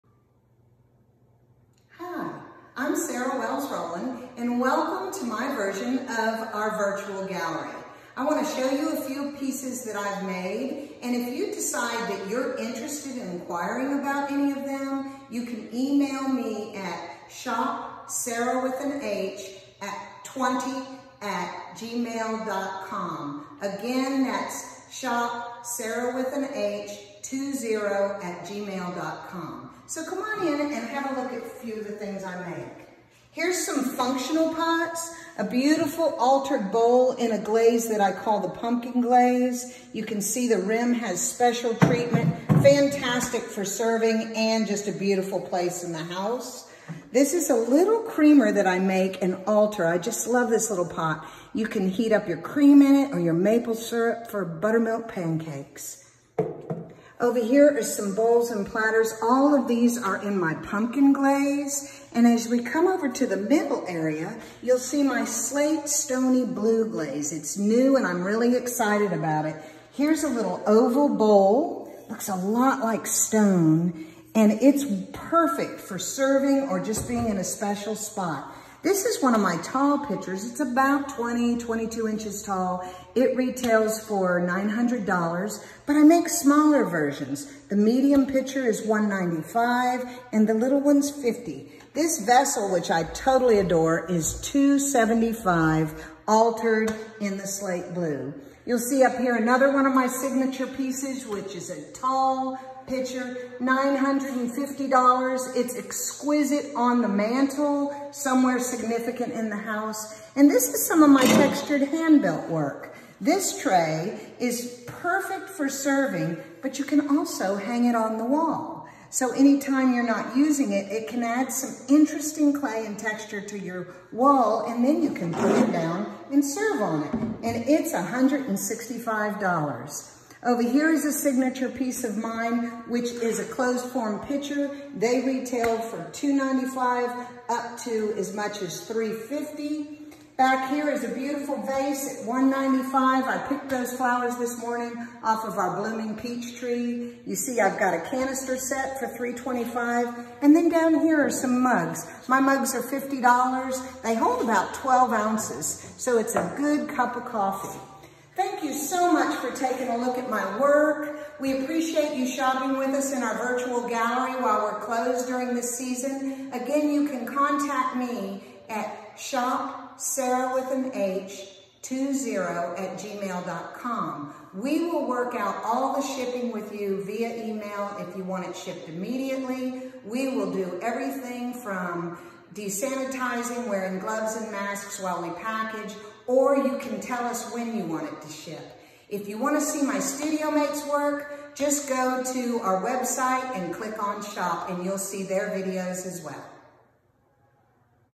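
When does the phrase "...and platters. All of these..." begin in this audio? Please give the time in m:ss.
0:58.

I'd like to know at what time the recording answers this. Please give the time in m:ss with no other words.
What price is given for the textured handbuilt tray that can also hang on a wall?
2:07.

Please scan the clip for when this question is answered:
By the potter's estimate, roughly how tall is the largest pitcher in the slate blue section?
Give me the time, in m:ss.
1:21.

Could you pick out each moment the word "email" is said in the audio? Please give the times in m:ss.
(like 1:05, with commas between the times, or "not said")
0:15, 2:57.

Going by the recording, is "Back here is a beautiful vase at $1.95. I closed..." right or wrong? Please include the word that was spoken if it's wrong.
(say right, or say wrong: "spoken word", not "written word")
wrong: "picked", not "closed".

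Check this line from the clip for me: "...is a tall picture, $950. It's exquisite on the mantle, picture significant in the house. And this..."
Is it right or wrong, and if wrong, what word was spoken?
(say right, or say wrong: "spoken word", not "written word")
wrong: "somewhere", not "picture".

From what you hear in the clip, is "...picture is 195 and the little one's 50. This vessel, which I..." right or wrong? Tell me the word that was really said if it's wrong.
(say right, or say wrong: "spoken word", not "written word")
right.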